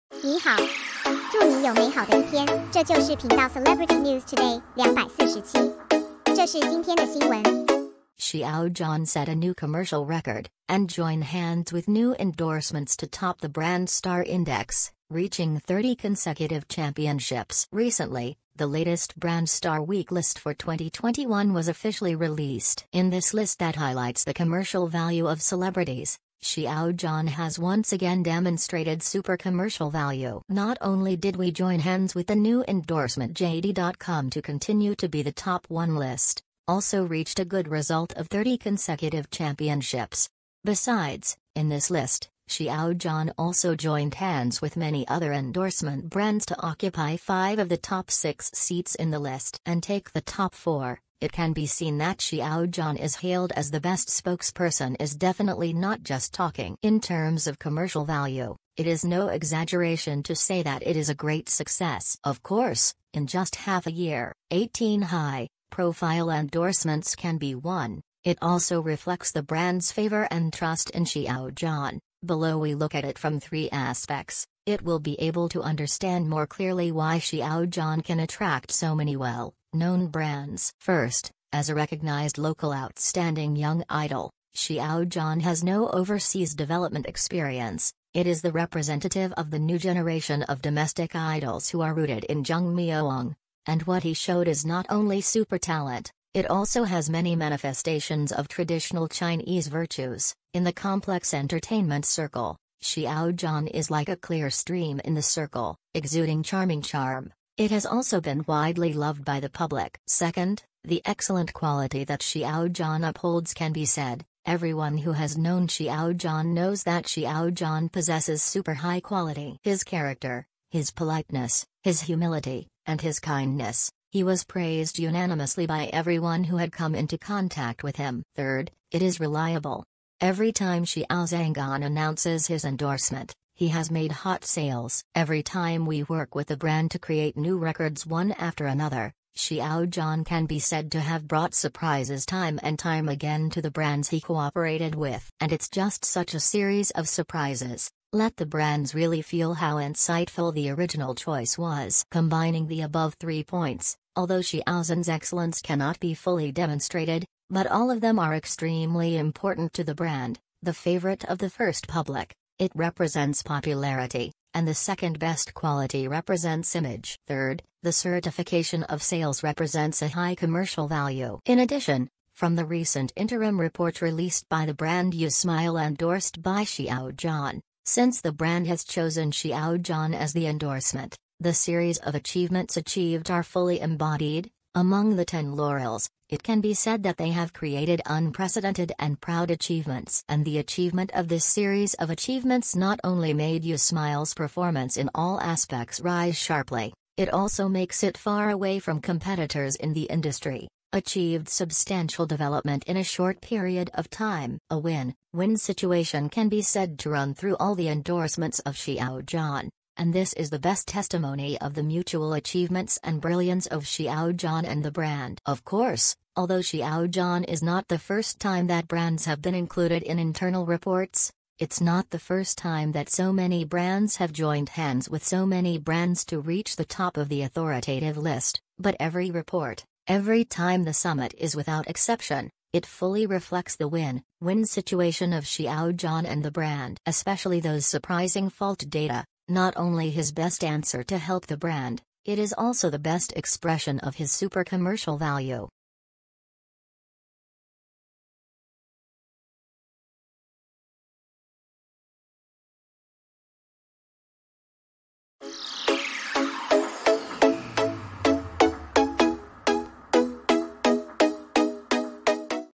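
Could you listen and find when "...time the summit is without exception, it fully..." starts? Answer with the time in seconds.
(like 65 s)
230 s.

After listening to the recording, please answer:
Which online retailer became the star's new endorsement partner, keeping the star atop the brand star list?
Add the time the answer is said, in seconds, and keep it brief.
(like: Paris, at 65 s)
JD.com, at 33 s.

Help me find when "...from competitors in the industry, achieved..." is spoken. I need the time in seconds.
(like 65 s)
198 s.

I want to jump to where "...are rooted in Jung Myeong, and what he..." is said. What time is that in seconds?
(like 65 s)
91 s.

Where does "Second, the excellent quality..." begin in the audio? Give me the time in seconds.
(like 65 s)
110 s.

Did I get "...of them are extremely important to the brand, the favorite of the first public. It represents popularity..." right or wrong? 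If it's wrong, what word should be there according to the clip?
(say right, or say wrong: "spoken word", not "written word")
right.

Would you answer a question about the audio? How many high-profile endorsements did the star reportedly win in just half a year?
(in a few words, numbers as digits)
18.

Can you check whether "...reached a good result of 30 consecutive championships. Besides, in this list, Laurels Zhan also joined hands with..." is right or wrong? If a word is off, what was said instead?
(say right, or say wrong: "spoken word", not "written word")
wrong: "Xiao", not "Laurels".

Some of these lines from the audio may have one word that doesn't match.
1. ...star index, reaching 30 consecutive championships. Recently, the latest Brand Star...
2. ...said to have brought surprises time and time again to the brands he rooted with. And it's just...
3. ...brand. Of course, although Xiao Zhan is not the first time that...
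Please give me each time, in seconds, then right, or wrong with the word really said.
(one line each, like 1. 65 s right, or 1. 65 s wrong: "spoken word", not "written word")
1. 13 s right
2. 140 s wrong: "cooperated", not "rooted"
3. 214 s right.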